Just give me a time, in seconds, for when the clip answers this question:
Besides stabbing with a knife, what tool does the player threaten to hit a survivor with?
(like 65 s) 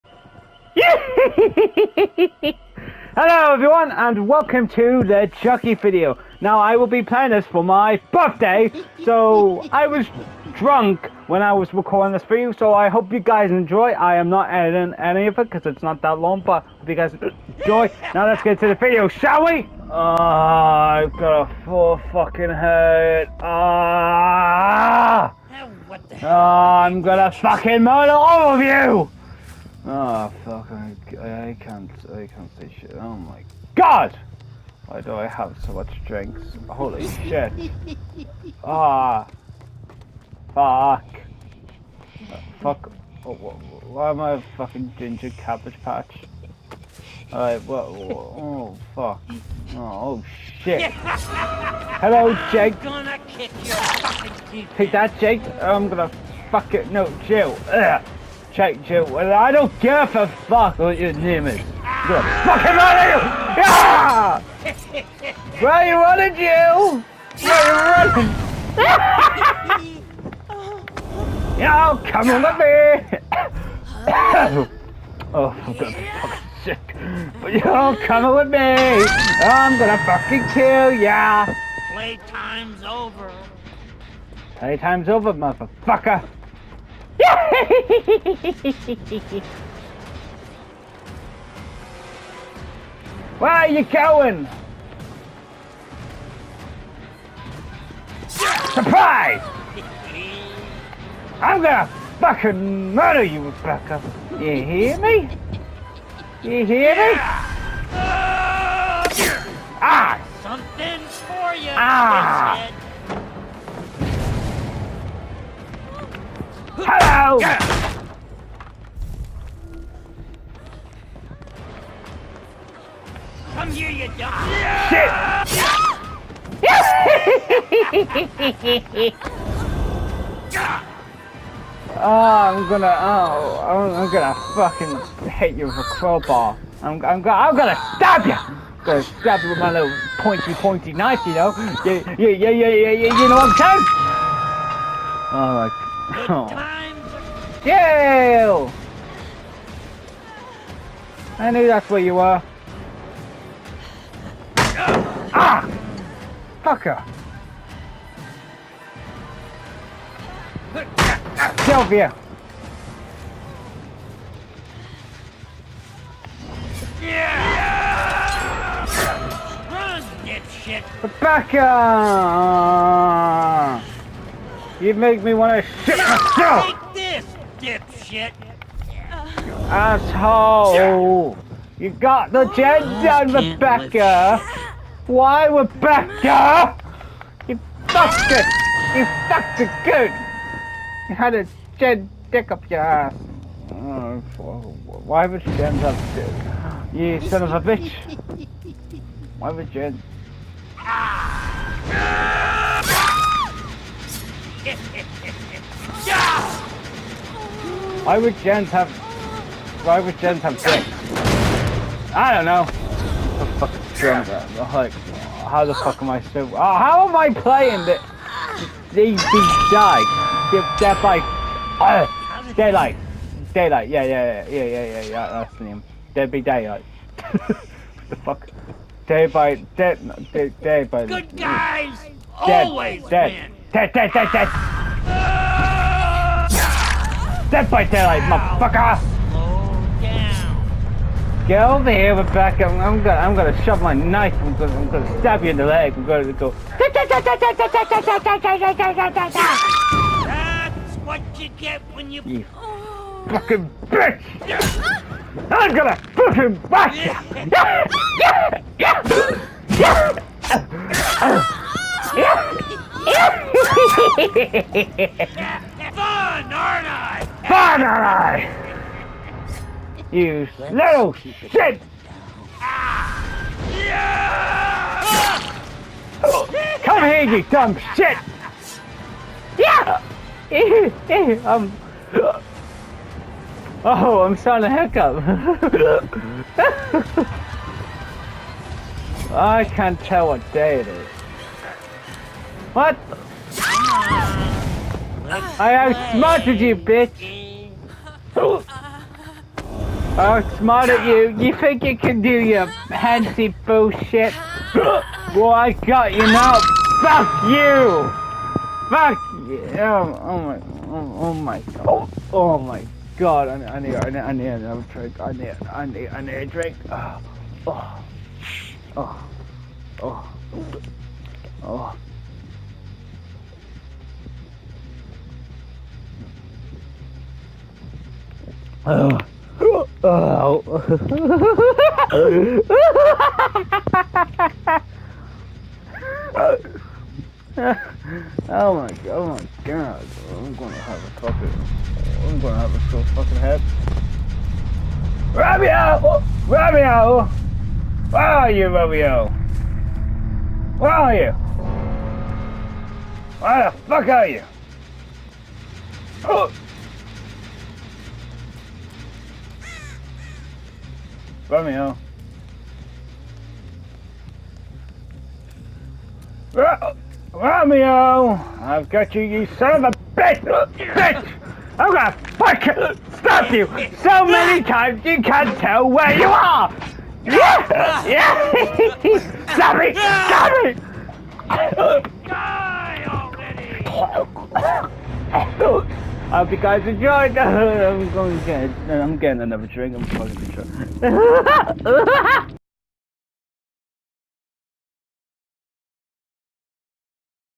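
135 s.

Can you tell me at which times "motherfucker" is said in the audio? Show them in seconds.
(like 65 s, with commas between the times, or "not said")
85 s, 238 s.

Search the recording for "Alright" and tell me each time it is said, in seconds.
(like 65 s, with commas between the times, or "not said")
47 s, 145 s.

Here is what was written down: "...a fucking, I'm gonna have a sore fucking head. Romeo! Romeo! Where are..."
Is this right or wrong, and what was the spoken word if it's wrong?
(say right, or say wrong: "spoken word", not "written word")
right.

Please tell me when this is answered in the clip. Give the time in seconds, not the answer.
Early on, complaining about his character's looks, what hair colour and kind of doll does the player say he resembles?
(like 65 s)
44 s.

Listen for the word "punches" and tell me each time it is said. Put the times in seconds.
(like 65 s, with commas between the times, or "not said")
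not said.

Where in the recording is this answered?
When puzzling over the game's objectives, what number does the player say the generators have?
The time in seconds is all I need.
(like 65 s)
210 s.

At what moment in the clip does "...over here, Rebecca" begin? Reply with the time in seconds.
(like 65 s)
241 s.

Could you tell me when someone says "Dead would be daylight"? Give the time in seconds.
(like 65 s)
226 s.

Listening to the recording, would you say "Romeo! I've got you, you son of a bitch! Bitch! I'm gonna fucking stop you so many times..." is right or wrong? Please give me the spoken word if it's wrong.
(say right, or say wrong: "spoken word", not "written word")
right.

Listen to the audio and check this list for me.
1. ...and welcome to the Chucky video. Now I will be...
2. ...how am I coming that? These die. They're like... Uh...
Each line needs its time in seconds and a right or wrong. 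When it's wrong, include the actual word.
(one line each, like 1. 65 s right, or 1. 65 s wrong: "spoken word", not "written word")
1. 3 s right
2. 216 s wrong: "playing", not "coming".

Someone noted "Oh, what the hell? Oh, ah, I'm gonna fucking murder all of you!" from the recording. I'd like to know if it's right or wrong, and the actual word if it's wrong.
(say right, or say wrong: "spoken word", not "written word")
right.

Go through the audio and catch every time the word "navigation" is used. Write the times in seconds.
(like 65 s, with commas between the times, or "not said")
not said.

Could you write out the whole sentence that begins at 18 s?
Now let's get to the video, shall we?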